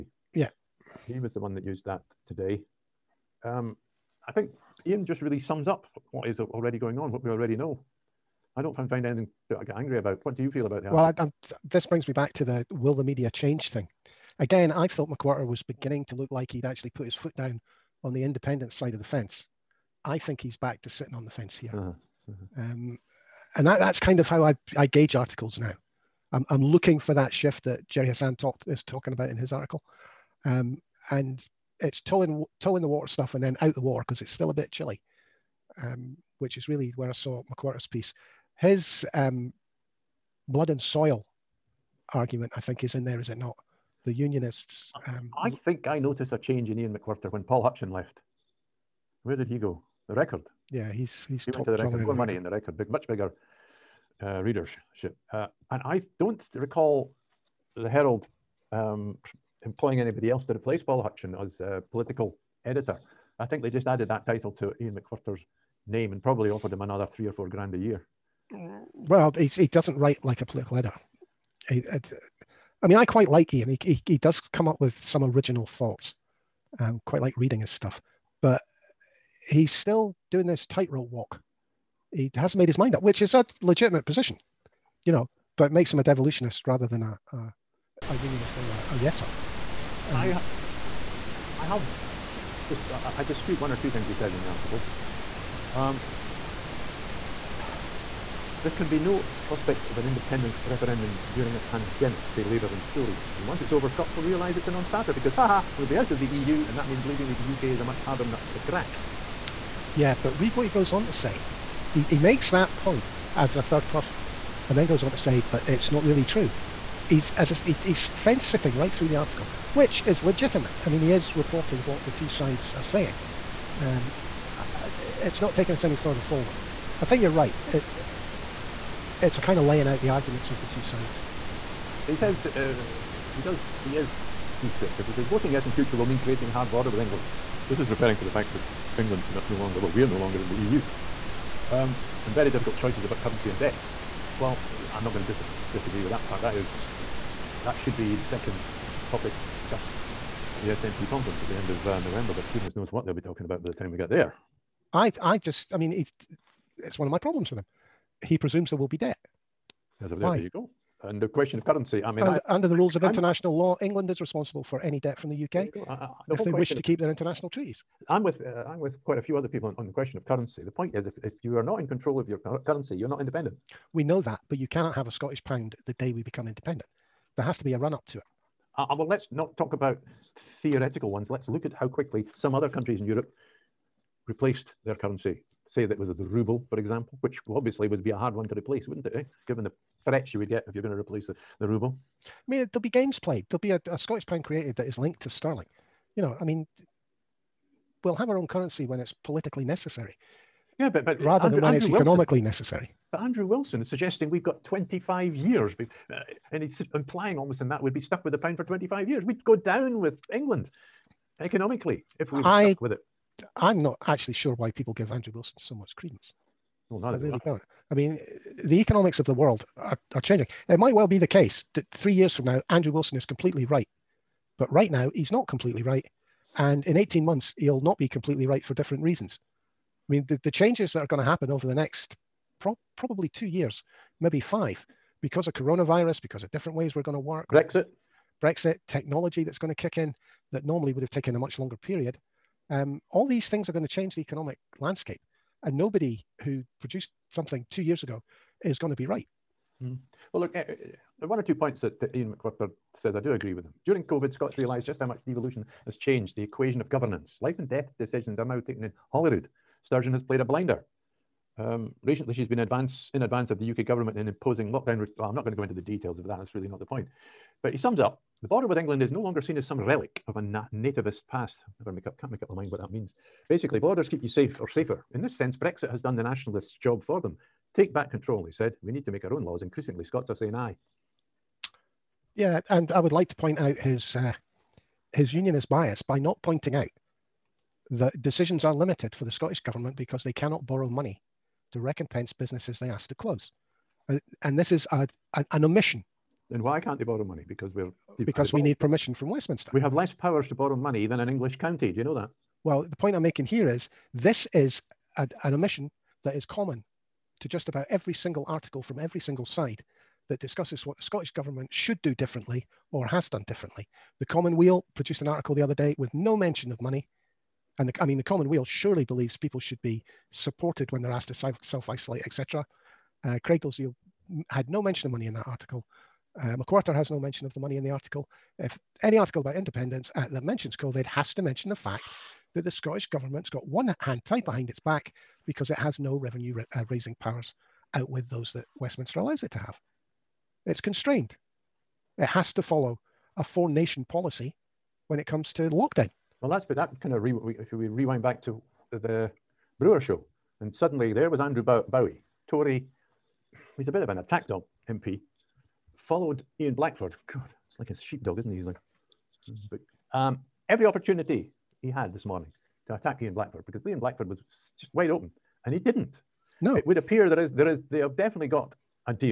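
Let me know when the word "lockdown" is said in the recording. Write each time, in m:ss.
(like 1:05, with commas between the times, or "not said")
4:24, 5:45.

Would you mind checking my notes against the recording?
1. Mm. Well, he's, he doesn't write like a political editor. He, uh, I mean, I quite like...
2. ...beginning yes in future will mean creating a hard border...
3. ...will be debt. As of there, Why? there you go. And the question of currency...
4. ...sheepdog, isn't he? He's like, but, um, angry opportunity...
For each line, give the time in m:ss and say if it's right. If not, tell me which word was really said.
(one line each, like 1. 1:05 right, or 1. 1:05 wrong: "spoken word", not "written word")
1. 1:08 right
2. 2:15 wrong: "voting", not "beginning"
3. 2:38 right
4. 5:57 wrong: "every", not "angry".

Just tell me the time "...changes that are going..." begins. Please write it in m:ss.
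3:50.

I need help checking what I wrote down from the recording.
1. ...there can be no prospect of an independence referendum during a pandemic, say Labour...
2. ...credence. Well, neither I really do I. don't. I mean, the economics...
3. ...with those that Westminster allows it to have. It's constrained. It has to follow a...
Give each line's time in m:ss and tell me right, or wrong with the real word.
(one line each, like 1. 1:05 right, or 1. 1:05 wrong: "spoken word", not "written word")
1. 1:38 right
2. 3:35 right
3. 5:38 right.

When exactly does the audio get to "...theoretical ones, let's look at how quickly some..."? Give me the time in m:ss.
3:00.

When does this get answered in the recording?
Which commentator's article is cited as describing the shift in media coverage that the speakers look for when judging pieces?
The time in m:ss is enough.
0:27.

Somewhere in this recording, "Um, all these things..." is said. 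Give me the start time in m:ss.
4:02.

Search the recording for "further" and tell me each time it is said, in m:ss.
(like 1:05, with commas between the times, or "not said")
2:05.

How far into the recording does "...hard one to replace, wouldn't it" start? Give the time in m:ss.
3:08.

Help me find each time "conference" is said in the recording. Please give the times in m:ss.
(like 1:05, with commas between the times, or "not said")
2:31.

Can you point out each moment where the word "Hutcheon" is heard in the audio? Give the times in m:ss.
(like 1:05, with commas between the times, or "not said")
0:47, 1:01.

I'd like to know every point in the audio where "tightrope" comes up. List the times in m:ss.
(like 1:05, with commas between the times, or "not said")
1:20.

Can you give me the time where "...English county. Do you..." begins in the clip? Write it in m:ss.
5:01.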